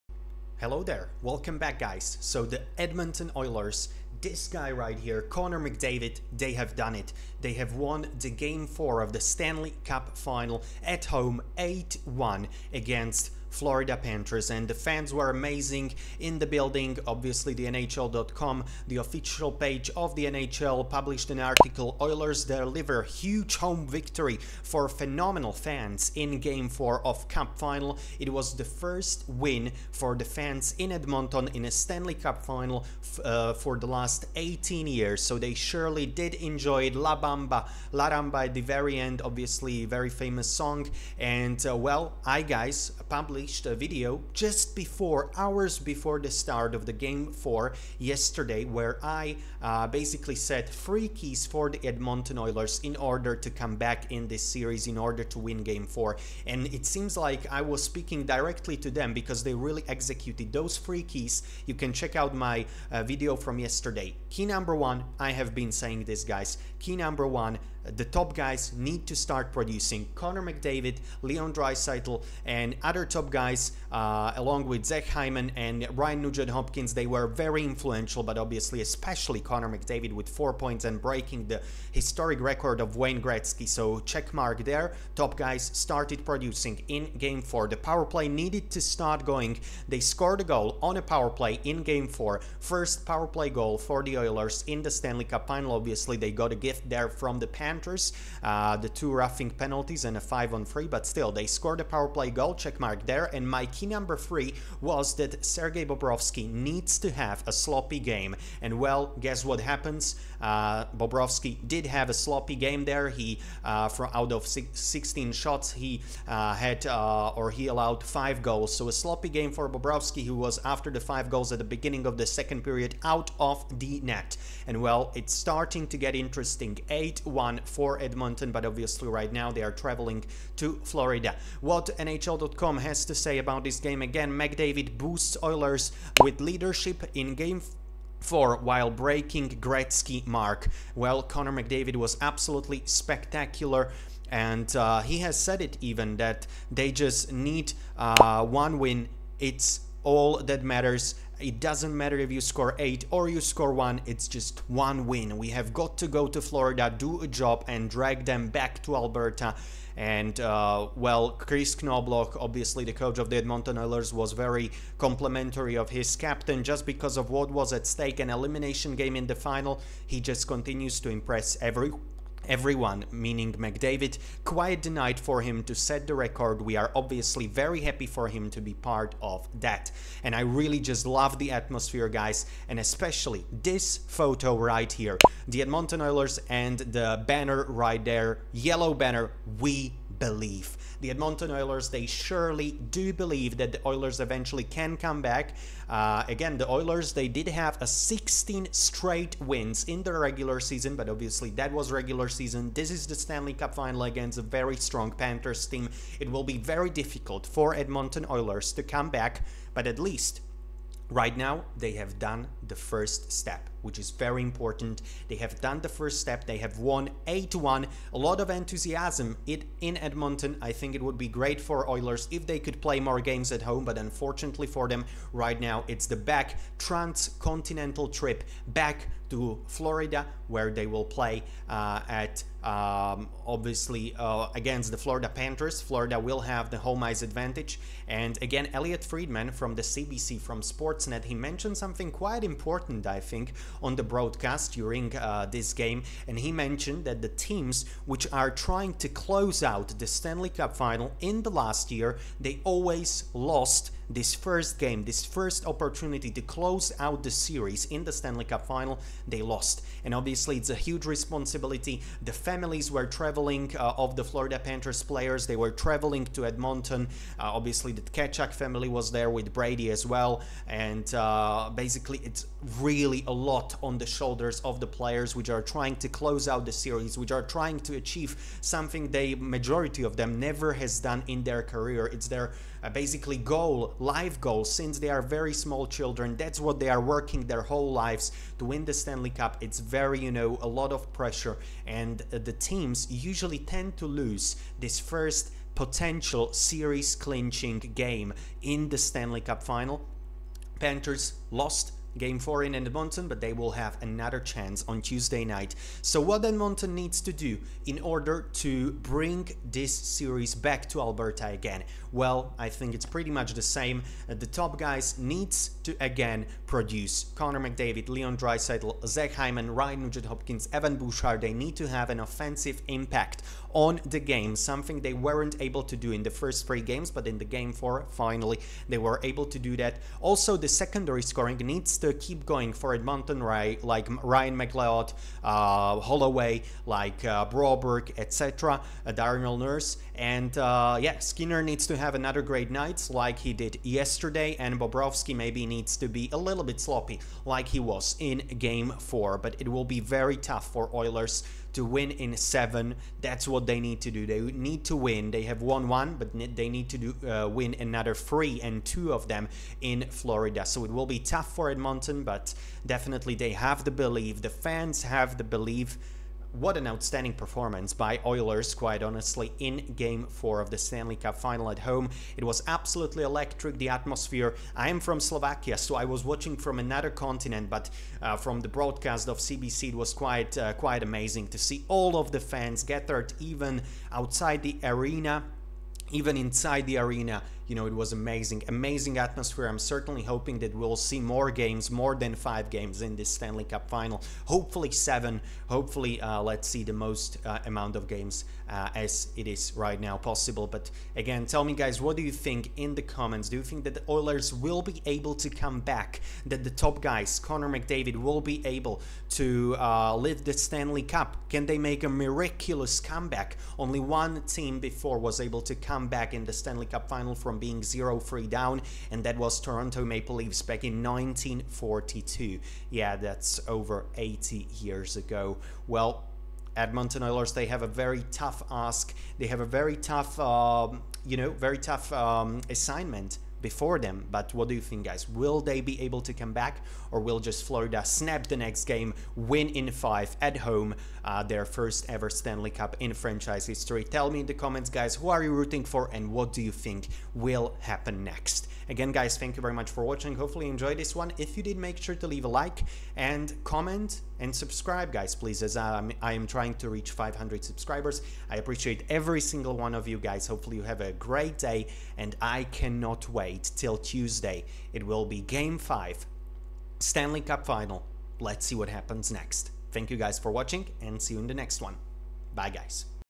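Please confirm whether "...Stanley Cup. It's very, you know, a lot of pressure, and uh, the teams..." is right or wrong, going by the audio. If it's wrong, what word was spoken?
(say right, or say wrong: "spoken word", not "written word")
right.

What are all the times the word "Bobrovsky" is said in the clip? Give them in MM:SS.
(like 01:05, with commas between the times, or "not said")
01:45, 01:50, 01:59, 05:44.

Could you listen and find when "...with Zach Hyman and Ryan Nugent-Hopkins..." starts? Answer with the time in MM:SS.
01:14.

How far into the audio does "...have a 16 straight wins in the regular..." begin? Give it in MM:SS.
03:17.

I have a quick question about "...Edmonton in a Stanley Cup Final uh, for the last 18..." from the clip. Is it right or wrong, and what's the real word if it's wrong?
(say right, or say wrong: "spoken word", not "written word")
right.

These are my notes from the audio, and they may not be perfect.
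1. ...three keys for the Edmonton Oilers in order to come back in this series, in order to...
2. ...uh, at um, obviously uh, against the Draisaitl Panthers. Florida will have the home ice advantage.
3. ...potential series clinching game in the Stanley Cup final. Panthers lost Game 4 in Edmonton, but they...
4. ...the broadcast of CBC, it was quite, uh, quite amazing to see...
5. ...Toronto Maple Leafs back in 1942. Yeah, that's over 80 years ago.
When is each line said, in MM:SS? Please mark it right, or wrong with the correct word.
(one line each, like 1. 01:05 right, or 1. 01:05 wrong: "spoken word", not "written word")
1. 00:50 right
2. 03:51 wrong: "Florida", not "Draisaitl"
3. 04:55 right
4. 06:18 right
5. 06:59 right.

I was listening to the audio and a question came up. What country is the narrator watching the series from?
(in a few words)
Slovakia.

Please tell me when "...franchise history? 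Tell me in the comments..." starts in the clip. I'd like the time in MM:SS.
07:23.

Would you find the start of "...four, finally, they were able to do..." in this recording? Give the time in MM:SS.
05:27.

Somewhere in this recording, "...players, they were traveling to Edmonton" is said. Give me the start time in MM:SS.
04:25.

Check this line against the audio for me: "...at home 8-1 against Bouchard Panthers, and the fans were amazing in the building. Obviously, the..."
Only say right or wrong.
wrong.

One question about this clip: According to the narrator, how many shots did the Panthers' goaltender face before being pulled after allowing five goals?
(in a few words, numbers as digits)
16.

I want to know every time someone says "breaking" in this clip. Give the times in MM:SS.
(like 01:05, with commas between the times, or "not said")
01:21, 02:18.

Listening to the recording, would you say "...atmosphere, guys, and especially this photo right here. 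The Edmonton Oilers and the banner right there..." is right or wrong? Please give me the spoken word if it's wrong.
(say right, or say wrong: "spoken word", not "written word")
right.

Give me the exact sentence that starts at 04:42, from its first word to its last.
It's their uh, basically goal, life goal, since they are very small children.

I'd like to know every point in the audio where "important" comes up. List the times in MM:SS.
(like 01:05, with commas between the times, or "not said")
03:34, 04:02.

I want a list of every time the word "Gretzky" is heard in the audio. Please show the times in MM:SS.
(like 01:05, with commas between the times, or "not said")
01:23, 02:19.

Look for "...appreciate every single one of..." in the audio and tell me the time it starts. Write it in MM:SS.
07:38.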